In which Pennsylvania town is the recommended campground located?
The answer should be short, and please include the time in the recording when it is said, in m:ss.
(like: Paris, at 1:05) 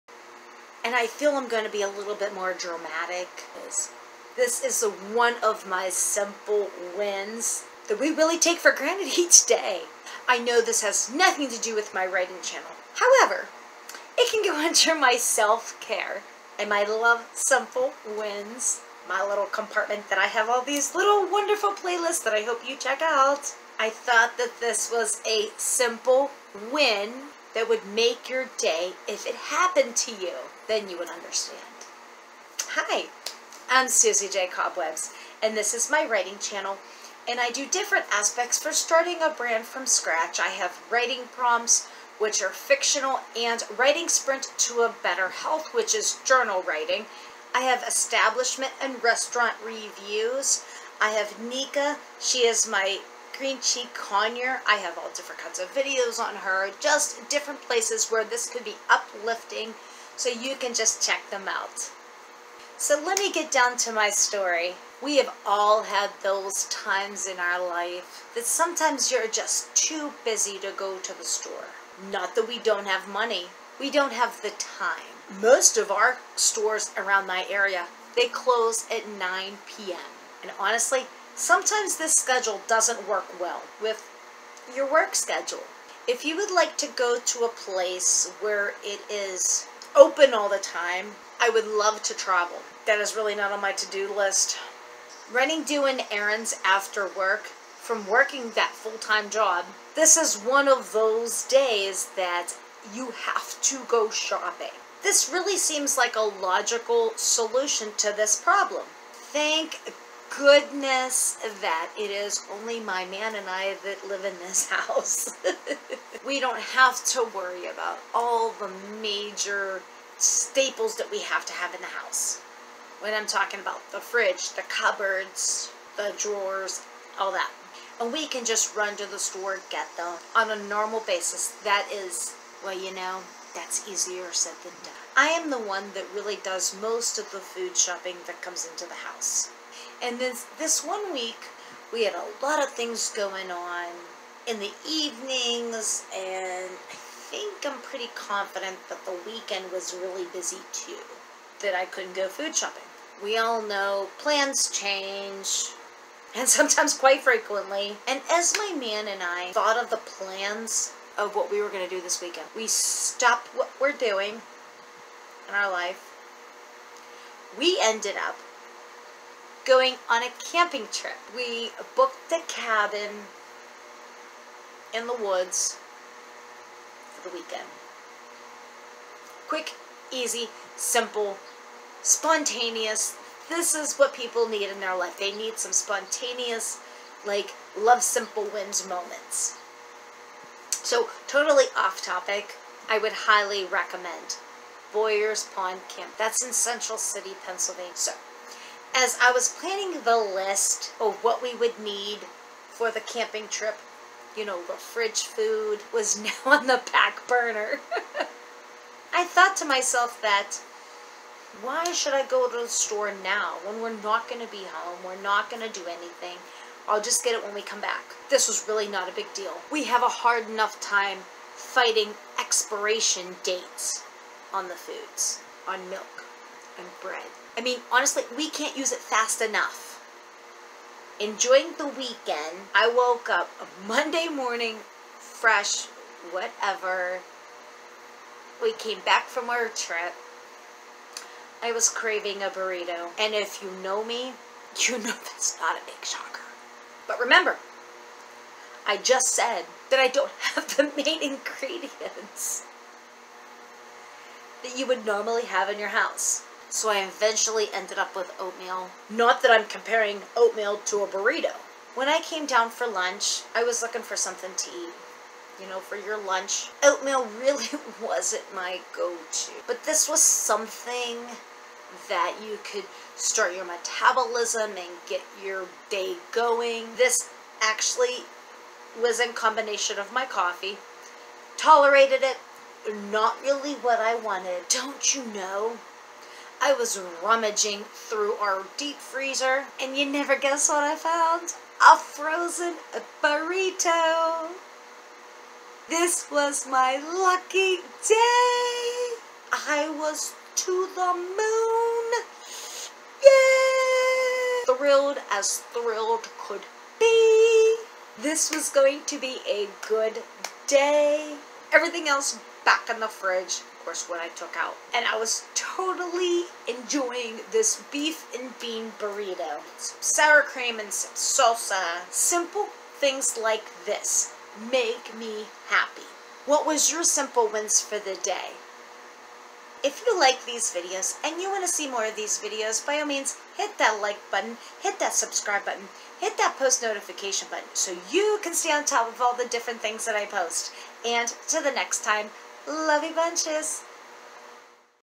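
Central City, at 3:16.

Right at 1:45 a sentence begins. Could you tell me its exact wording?
This really seems like a logical solution to this problem.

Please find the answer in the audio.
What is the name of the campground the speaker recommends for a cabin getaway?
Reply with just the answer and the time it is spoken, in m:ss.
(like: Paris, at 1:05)
Boyer's Pond Camp, at 3:14.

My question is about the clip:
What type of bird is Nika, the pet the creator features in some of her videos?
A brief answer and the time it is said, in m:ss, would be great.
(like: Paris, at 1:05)
green cheek conure, at 0:53.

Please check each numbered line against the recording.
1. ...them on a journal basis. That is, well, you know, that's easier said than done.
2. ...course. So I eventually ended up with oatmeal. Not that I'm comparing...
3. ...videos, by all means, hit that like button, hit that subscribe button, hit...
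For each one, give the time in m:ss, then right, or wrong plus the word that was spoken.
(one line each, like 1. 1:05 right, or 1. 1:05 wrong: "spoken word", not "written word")
1. 2:09 wrong: "normal", not "journal"
2. 4:15 wrong: "house", not "course"
3. 5:32 right.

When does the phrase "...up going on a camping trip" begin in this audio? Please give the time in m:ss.
2:48.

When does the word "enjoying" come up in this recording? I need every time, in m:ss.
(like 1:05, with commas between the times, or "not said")
3:51, 5:16.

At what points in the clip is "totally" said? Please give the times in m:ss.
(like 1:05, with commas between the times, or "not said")
3:11, 5:15.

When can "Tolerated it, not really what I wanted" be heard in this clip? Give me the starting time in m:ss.
4:41.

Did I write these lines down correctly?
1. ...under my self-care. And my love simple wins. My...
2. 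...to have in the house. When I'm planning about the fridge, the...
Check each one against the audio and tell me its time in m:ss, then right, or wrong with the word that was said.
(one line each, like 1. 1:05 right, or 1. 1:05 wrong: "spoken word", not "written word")
1. 0:14 right
2. 2:01 wrong: "talking", not "planning".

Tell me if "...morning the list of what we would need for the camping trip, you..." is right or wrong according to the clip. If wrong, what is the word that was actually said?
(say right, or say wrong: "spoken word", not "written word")
wrong: "planning", not "morning".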